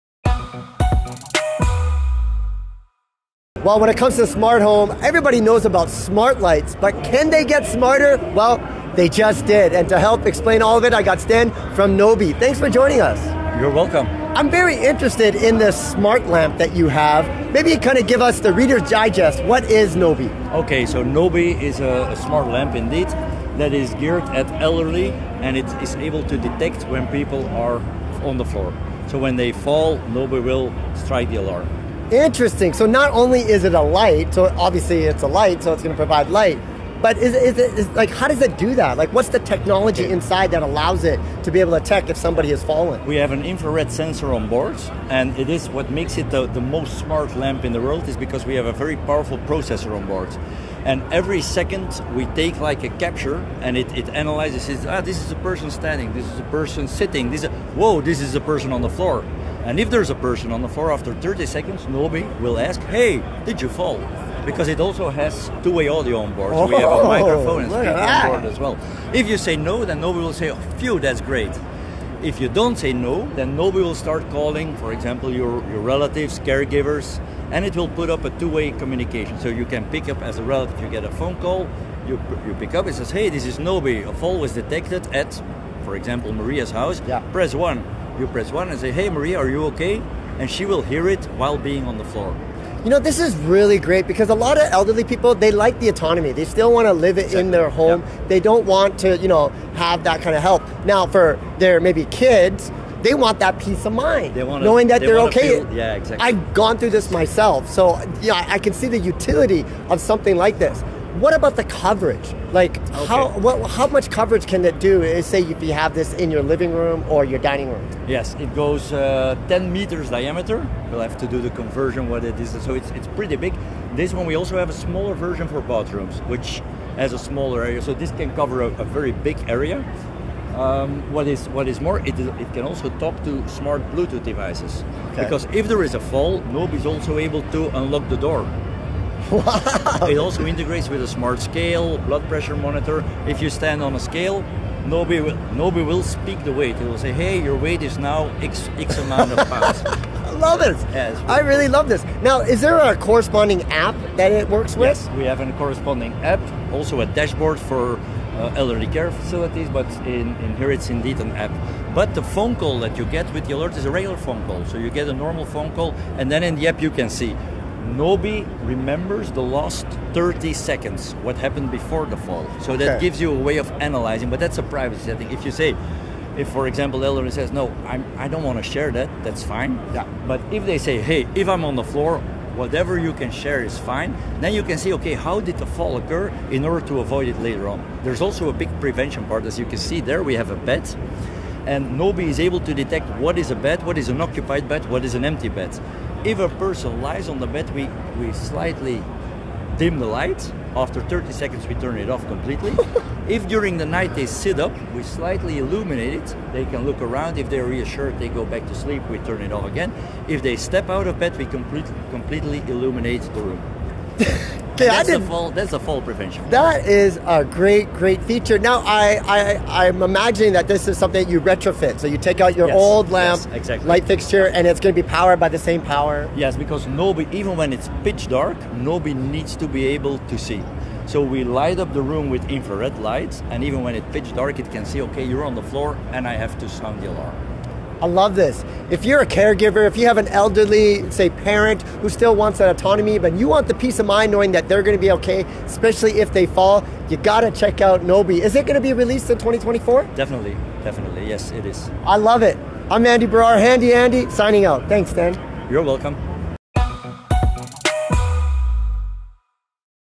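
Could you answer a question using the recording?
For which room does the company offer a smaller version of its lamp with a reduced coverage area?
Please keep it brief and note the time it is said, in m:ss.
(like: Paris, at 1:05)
Bathrooms, at 2:05.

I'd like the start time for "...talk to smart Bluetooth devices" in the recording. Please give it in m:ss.
2:12.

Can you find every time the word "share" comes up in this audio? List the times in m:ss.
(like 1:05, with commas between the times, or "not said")
2:58, 3:03.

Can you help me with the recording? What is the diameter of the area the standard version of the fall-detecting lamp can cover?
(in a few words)
10 meters.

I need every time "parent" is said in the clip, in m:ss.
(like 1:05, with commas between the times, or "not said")
4:01.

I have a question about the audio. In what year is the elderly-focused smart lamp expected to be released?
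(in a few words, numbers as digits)
2024.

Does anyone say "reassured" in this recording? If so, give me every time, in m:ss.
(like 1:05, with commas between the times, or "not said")
3:27.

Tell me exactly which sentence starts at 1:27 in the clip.
press one you press one and say, "Hey, Maria, are you okay?" And she will hear it while being on the floor.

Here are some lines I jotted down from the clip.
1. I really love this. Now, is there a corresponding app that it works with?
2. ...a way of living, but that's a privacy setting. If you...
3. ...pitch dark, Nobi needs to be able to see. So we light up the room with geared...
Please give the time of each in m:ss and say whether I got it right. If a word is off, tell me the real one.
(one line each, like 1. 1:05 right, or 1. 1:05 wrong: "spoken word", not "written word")
1. 2:31 right
2. 2:53 wrong: "analyzing", not "living"
3. 3:48 wrong: "infrared", not "geared".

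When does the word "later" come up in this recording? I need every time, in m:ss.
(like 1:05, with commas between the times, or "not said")
3:07.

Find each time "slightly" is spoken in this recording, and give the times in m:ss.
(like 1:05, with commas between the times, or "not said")
3:18, 3:25.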